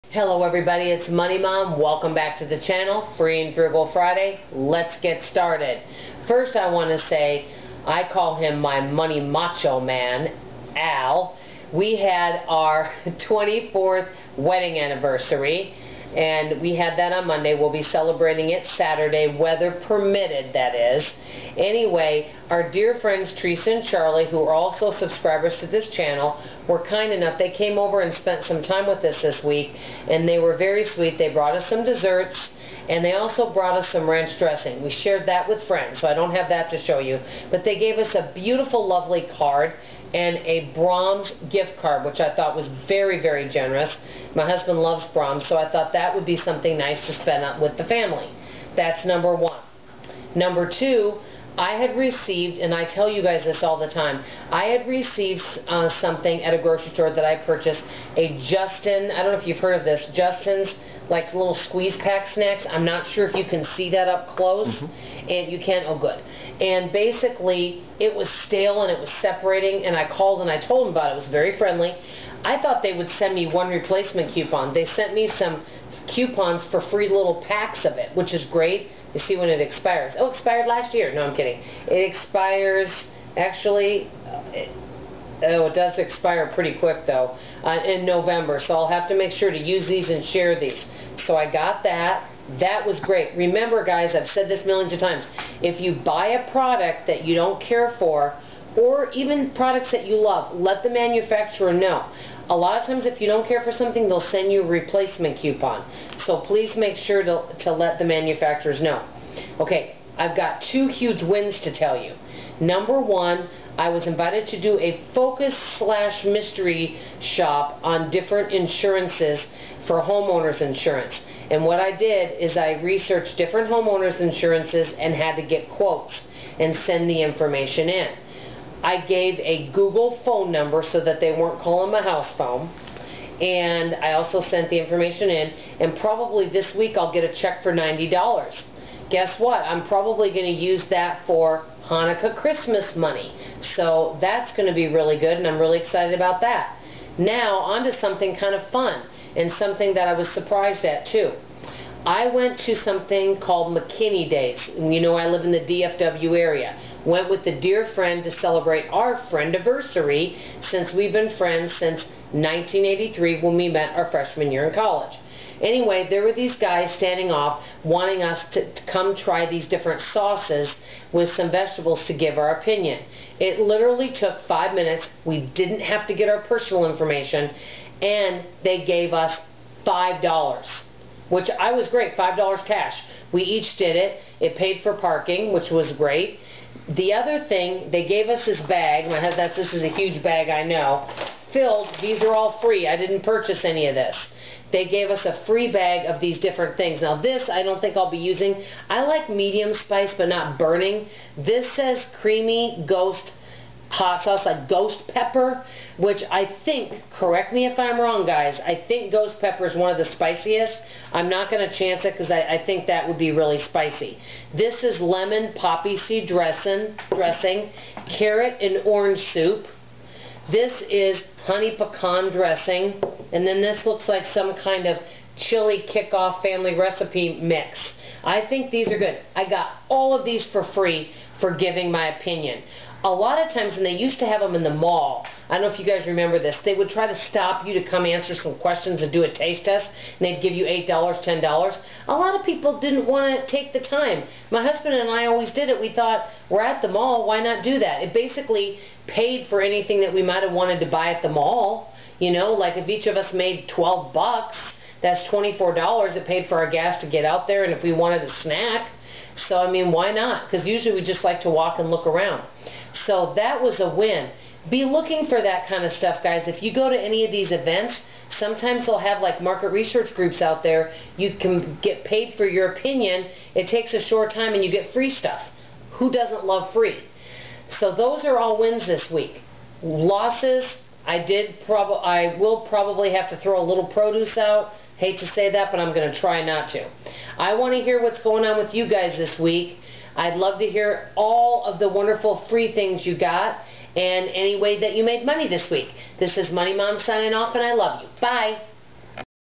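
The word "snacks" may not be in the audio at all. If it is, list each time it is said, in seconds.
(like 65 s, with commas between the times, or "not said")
62 s, 258 s.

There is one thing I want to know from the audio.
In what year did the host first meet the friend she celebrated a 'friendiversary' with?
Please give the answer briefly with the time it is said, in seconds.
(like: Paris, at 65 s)
1983, at 162 s.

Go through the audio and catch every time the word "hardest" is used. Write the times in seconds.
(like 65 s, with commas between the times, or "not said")
not said.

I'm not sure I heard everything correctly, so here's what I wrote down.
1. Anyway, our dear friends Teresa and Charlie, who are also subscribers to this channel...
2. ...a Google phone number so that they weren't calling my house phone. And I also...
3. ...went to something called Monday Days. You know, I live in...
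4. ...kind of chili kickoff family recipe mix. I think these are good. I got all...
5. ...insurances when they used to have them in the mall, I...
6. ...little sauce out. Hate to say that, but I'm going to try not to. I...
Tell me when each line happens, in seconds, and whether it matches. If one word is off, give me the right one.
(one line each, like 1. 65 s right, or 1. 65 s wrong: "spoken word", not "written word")
1. 21 s right
2. 129 s right
3. 152 s wrong: "McKinney", not "Monday"
4. 224 s right
5. 233 s wrong: "times", not "insurances"
6. 283 s wrong: "produce", not "sauce".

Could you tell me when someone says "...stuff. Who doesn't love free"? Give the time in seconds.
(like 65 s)
275 s.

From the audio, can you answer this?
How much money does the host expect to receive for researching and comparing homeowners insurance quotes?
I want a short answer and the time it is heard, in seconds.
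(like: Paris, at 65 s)
$90, at 137 s.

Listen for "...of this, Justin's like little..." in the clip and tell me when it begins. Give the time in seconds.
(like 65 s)
59 s.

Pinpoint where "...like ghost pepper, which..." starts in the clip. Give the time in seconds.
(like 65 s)
204 s.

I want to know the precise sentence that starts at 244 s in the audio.
My husband and I always did it.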